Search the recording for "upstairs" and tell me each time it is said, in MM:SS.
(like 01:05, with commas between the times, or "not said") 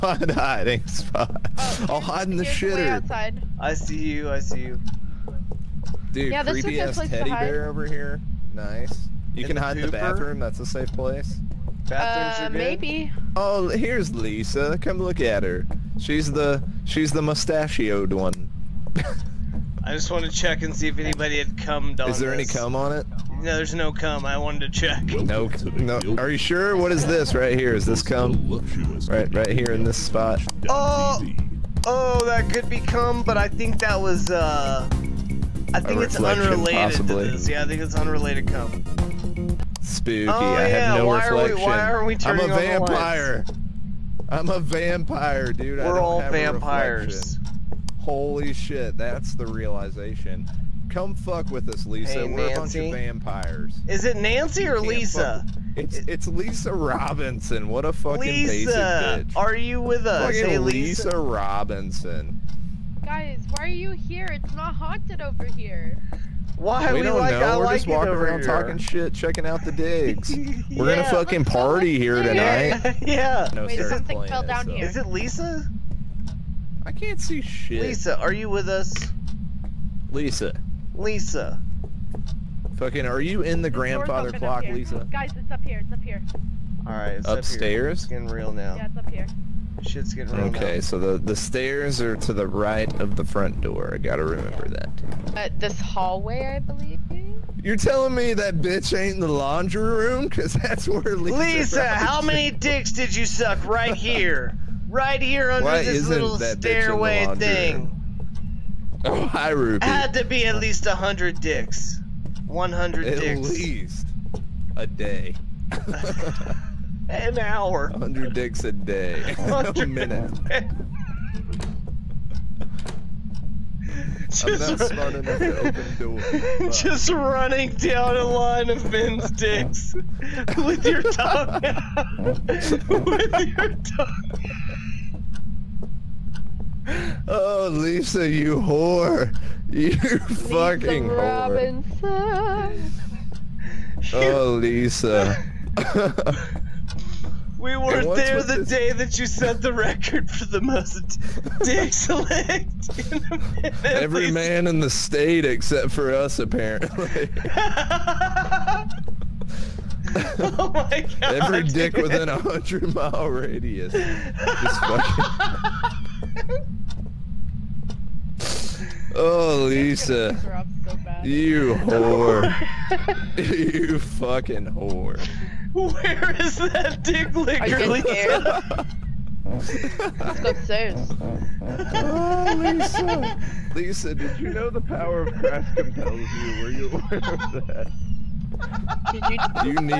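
01:27, 03:00.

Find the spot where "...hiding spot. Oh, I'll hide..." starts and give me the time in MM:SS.
00:00.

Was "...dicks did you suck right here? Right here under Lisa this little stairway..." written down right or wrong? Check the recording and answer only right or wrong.
wrong.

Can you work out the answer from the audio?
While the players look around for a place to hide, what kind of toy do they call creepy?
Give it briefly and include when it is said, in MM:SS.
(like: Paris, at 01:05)
teddy bear, at 00:07.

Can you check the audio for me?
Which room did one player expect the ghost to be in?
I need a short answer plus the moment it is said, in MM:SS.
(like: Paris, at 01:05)
laundry room, at 01:39.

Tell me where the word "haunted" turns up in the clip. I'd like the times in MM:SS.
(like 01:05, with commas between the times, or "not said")
01:04.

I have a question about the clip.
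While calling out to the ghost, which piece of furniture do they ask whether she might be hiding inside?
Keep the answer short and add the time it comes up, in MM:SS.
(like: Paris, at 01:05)
grandfather clock, at 01:23.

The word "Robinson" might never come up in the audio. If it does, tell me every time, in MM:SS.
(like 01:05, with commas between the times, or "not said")
00:56, 01:01, 02:21.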